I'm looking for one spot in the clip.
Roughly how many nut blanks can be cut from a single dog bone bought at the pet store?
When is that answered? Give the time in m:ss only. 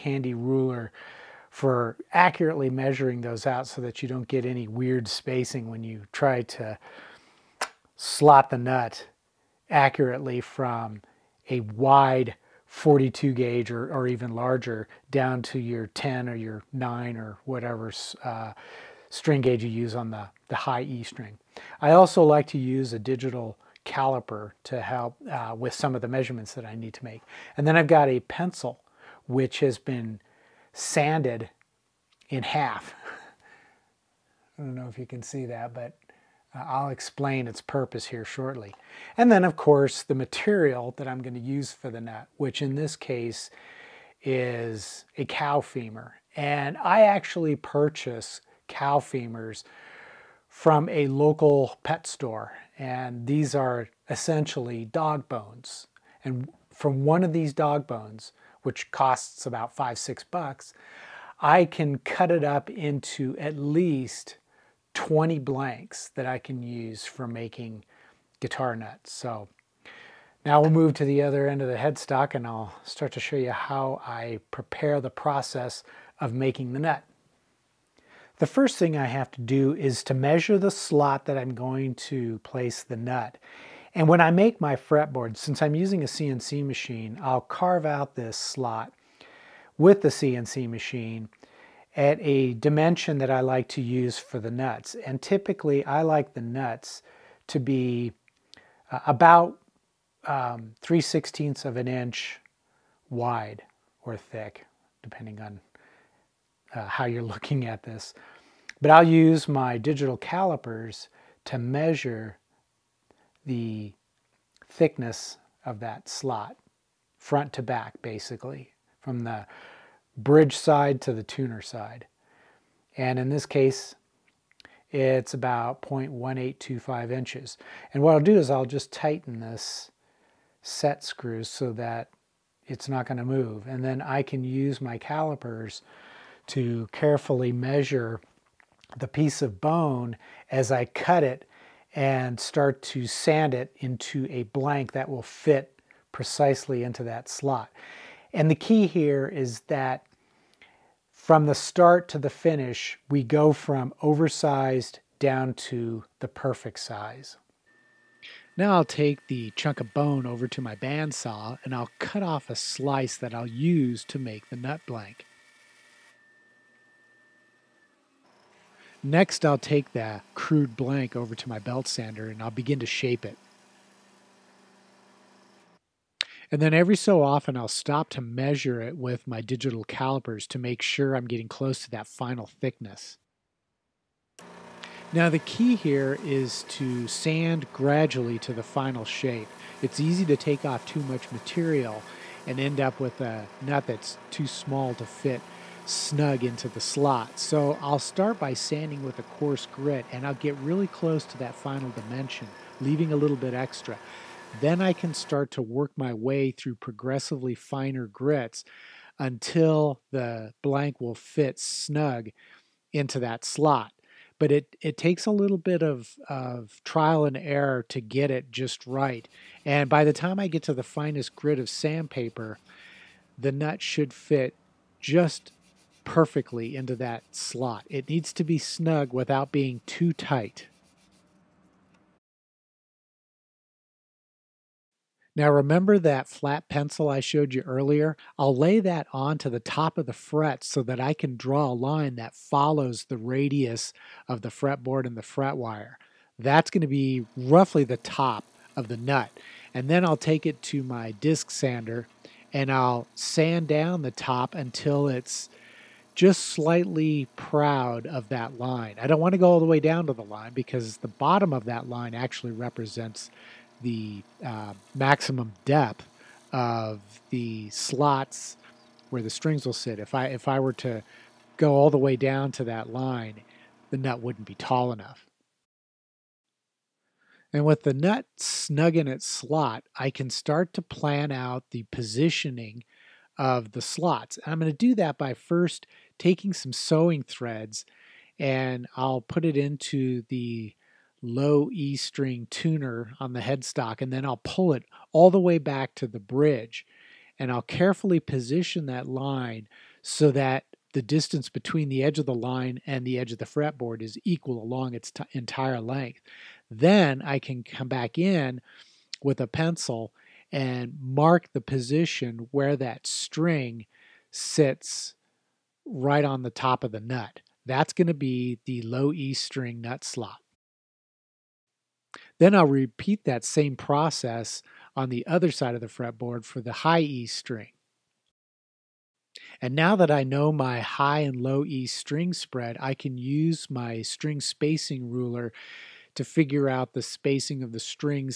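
1:04.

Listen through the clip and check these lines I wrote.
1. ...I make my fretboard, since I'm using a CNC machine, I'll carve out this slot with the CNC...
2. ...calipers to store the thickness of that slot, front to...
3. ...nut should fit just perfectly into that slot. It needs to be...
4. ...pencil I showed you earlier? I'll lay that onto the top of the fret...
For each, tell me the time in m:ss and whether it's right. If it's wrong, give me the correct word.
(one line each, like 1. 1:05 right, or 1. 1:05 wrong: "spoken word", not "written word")
1. 1:24 right
2. 1:50 wrong: "measure", not "store"
3. 3:43 right
4. 3:56 right.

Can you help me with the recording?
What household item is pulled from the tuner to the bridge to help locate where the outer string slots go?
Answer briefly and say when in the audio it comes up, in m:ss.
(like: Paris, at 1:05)
Sewing threads, at 4:46.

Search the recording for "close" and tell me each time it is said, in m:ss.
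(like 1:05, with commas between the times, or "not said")
3:01, 3:20.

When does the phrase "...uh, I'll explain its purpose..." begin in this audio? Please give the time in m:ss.
0:36.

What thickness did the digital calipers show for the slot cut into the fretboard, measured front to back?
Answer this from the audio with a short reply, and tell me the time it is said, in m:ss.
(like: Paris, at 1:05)
0.1825 inches, at 2:05.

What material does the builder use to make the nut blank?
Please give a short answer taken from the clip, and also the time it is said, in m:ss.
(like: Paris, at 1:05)
Cow femur, at 0:45.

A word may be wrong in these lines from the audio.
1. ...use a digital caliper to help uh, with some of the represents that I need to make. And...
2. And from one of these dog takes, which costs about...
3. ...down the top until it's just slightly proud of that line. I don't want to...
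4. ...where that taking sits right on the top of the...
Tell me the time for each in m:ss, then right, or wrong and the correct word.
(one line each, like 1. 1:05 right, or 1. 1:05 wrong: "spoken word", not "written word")
1. 0:22 wrong: "measurements", not "represents"
2. 0:56 wrong: "bones", not "takes"
3. 4:13 right
4. 5:12 wrong: "string", not "taking".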